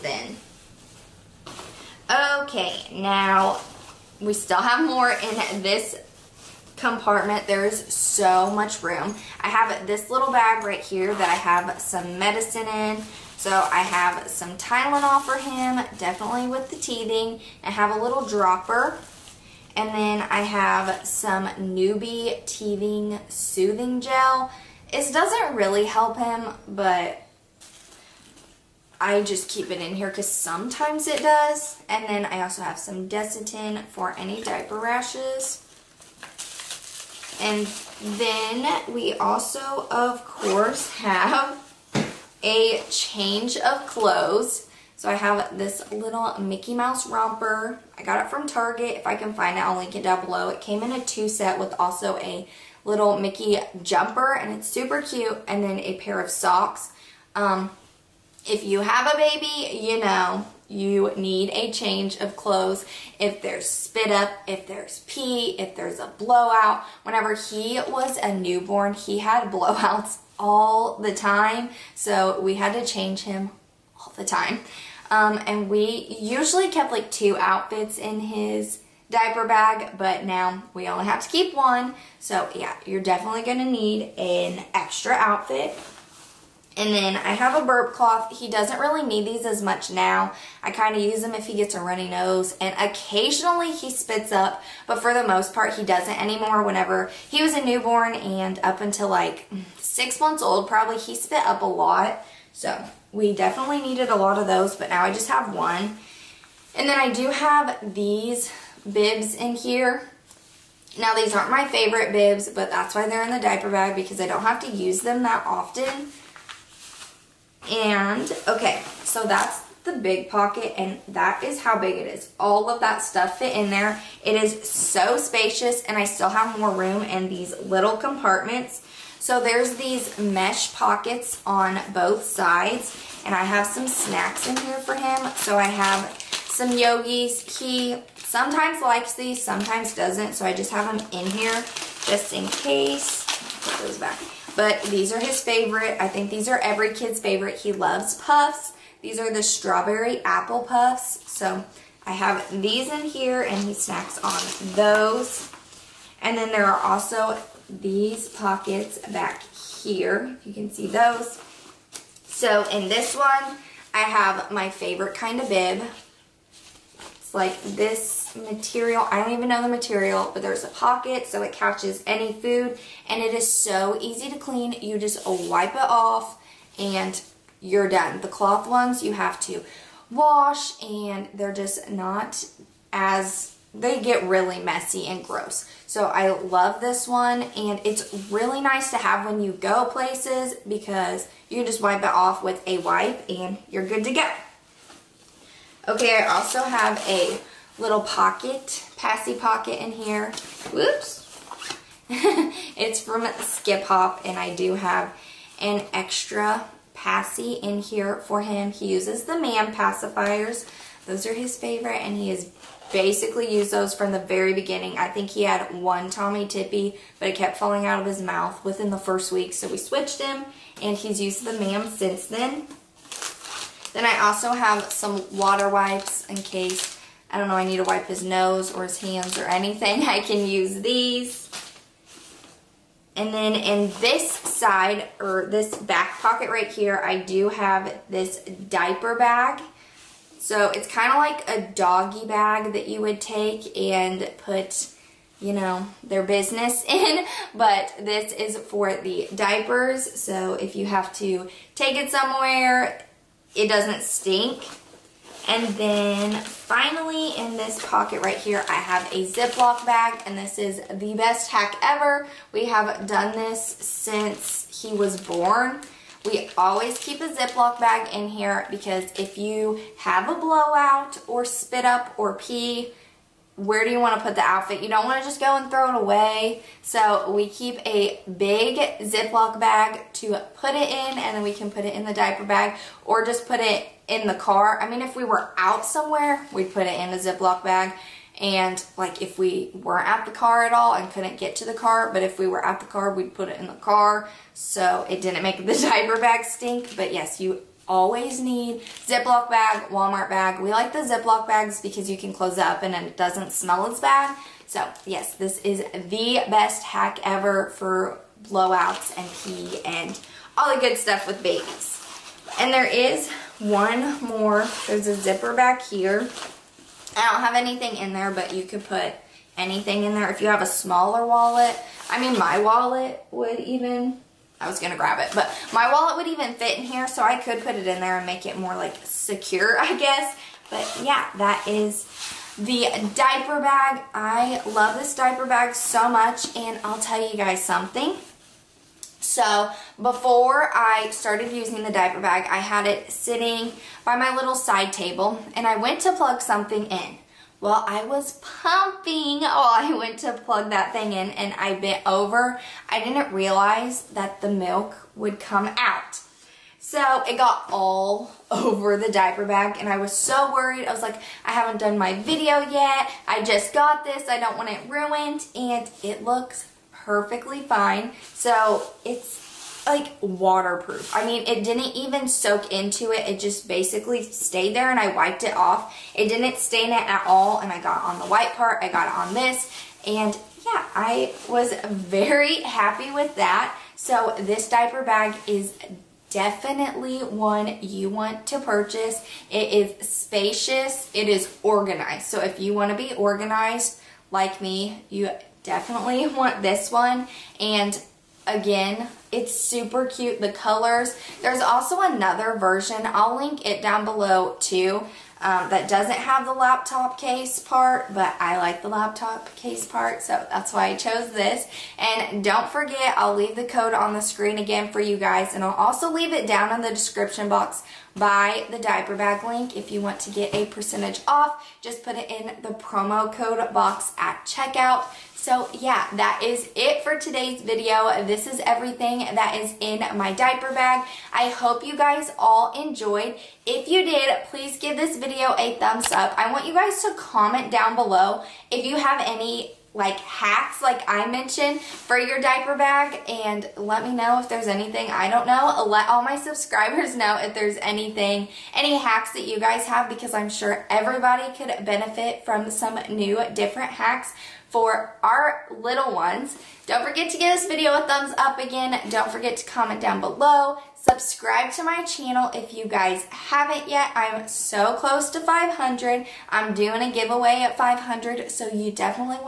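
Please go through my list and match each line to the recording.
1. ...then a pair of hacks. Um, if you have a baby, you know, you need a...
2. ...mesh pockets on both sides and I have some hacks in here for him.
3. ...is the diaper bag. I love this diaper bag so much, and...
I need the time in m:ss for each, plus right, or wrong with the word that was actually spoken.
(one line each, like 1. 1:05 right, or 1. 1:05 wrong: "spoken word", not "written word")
1. 0:55 wrong: "socks", not "hacks"
2. 2:10 wrong: "snacks", not "hacks"
3. 5:31 right.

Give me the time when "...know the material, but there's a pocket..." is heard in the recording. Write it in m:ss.
2:49.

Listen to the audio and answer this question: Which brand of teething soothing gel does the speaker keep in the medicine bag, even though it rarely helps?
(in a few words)
Nuby.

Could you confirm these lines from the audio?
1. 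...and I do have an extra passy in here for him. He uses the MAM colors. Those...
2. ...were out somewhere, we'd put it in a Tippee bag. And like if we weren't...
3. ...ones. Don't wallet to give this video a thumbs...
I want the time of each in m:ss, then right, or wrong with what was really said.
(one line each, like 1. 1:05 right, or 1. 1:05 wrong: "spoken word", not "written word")
1. 3:24 wrong: "pacifiers", not "colors"
2. 4:45 wrong: "Ziploc", not "Tippee"
3. 7:36 wrong: "forget", not "wallet".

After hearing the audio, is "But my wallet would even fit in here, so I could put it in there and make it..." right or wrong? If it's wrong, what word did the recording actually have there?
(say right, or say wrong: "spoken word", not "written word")
right.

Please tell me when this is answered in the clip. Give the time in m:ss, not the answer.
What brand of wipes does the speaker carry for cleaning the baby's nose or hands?
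3:45.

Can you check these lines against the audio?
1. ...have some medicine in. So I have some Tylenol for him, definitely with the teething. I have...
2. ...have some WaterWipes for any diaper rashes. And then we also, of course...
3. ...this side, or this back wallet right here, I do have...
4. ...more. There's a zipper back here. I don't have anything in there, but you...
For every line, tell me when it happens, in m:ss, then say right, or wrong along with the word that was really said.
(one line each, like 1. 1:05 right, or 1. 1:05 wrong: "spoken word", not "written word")
1. 0:11 right
2. 0:32 wrong: "Desitin", not "WaterWipes"
3. 3:54 wrong: "pocket", not "wallet"
4. 5:14 right.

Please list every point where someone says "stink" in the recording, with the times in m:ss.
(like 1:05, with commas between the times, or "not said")
4:14, 4:56.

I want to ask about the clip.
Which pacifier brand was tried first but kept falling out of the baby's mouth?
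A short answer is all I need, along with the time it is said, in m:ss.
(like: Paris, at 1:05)
Tommee Tippee, at 3:36.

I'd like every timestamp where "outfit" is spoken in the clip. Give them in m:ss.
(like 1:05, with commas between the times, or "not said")
1:17, 1:25, 4:34.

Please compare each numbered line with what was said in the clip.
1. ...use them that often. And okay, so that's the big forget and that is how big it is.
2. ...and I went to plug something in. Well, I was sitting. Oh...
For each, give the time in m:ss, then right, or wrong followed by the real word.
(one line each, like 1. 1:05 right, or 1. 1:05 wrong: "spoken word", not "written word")
1. 1:54 wrong: "pocket", not "forget"
2. 5:45 wrong: "pumping", not "sitting".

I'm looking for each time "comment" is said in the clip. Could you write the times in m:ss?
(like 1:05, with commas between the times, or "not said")
7:17, 7:39.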